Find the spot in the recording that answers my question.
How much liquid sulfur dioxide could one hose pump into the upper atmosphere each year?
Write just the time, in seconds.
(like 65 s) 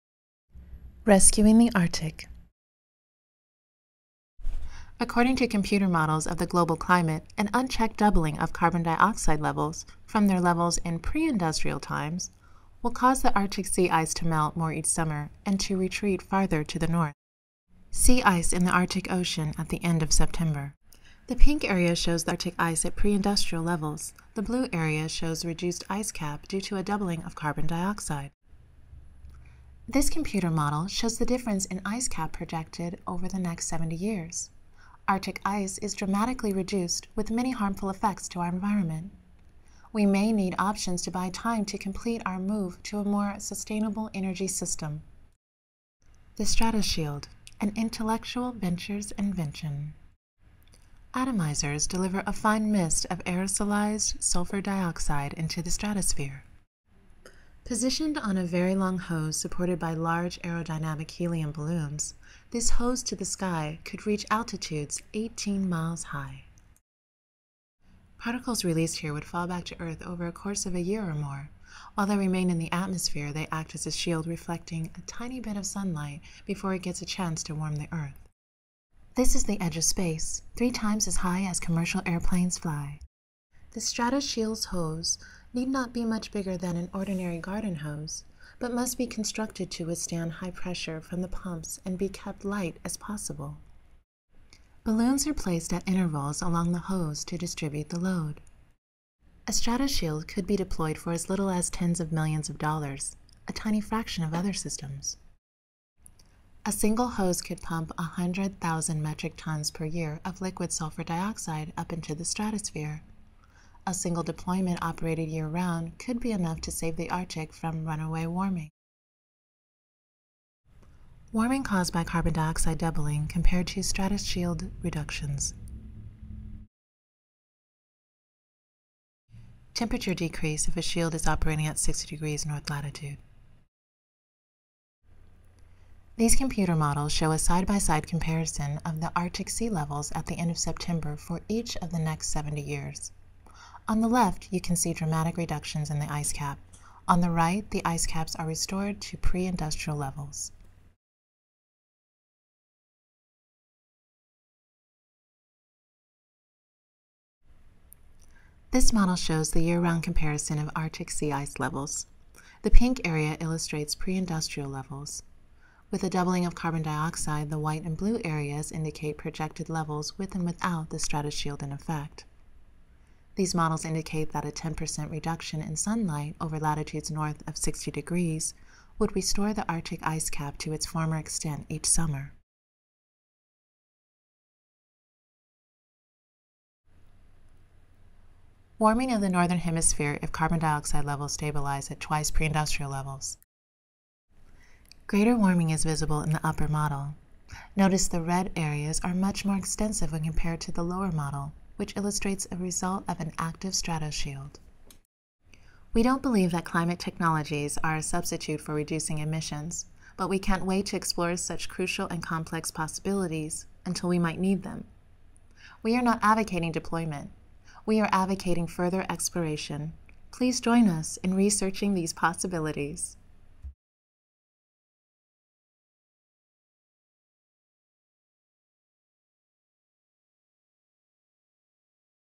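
107 s.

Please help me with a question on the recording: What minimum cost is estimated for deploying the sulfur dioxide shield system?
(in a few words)
tens of millions of dollars.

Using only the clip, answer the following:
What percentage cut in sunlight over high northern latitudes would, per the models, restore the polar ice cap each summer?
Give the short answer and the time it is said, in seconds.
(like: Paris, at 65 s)
10%, at 174 s.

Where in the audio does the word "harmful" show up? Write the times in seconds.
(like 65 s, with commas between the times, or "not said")
37 s.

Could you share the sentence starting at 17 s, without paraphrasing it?
Sea ice in the Arctic Ocean at the end of September.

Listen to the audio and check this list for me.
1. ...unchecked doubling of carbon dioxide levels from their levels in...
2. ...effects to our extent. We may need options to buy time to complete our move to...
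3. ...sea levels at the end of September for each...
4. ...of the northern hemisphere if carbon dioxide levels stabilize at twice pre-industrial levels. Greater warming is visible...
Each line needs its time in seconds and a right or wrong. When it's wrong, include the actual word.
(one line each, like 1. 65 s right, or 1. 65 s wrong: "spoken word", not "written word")
1. 7 s right
2. 37 s wrong: "environment", not "extent"
3. 139 s right
4. 189 s right.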